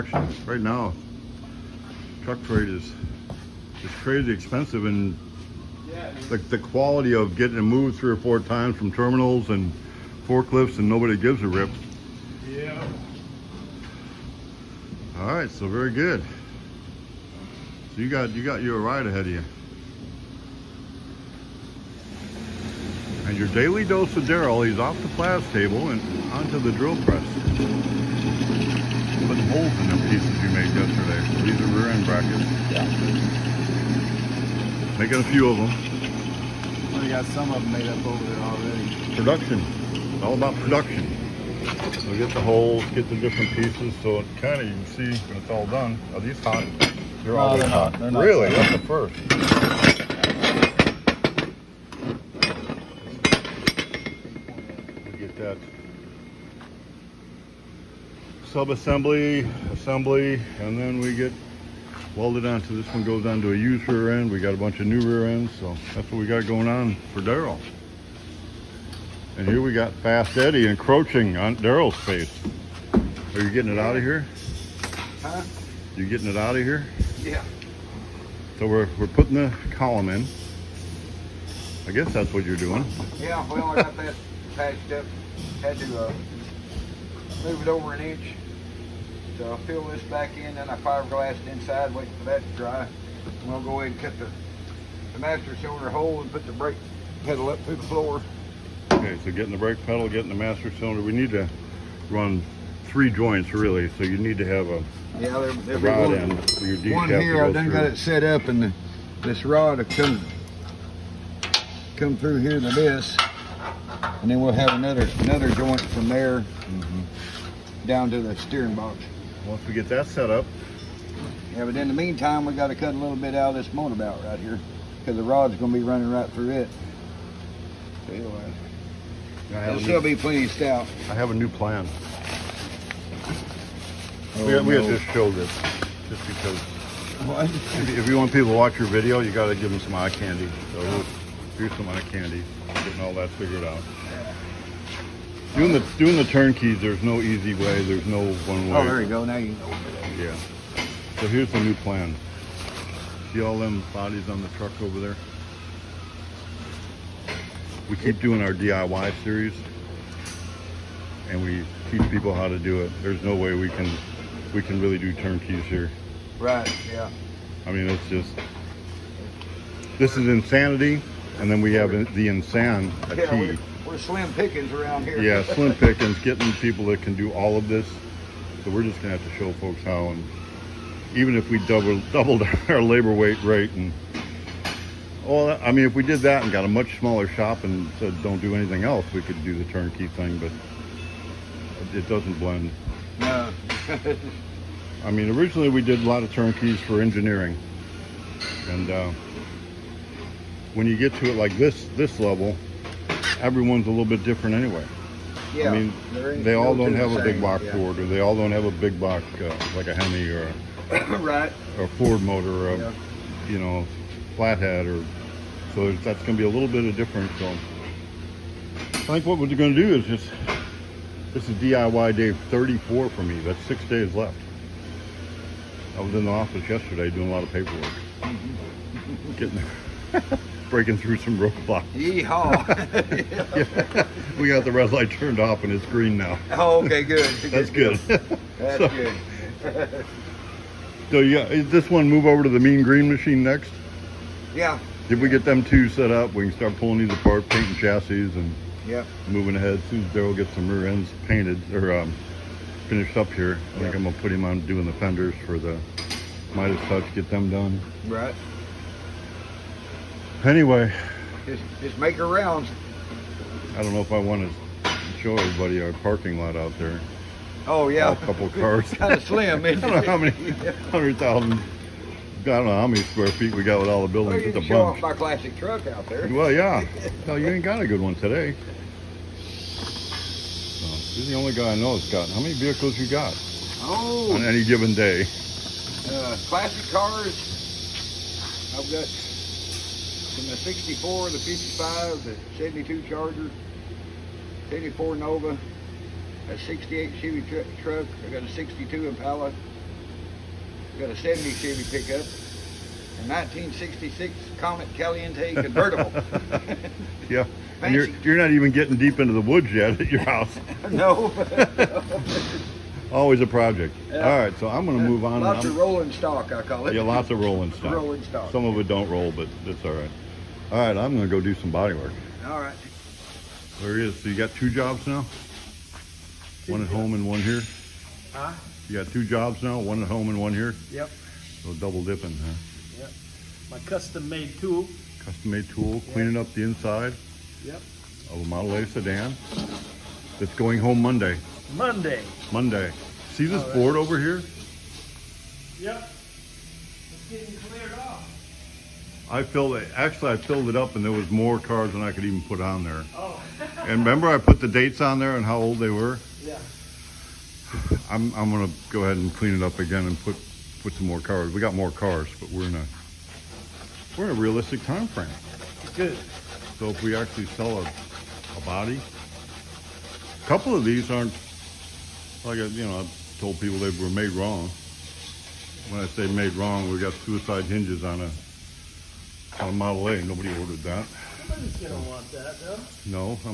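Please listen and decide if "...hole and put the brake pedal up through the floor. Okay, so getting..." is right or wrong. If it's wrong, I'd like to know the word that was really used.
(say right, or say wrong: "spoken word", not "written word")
right.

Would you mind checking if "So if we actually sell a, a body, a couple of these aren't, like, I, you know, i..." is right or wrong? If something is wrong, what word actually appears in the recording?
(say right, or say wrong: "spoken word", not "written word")
right.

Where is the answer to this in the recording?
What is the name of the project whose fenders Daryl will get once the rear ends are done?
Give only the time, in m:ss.
4:16.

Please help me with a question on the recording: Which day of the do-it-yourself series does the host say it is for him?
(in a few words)
Day 34.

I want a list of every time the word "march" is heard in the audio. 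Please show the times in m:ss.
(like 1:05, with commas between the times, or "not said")
not said.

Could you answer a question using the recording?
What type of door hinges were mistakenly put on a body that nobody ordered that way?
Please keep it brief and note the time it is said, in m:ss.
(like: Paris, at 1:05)
Suicide hinges, at 6:17.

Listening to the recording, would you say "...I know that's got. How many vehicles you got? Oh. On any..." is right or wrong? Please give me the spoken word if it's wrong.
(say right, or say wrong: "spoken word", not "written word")
right.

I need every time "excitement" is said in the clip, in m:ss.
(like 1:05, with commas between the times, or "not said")
not said.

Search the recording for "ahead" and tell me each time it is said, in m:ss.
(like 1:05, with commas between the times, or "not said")
0:19, 1:33, 4:09, 5:59.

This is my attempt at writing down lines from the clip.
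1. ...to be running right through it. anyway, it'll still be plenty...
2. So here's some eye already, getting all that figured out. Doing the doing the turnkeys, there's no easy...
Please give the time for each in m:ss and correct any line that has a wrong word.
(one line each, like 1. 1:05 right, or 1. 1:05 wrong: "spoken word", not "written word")
1. 2:05 right
2. 2:20 wrong: "candy", not "already".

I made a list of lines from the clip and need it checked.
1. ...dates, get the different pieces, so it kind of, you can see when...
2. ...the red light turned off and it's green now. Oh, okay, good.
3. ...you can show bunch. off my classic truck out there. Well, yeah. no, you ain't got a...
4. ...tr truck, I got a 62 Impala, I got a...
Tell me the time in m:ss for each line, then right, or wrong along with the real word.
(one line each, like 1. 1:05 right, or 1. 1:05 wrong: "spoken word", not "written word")
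1. 0:42 wrong: "holes", not "dates"
2. 3:54 right
3. 4:34 right
4. 4:57 right.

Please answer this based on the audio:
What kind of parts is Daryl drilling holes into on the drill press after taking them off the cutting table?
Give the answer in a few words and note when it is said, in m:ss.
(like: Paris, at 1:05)
Rear end brackets, at 0:31.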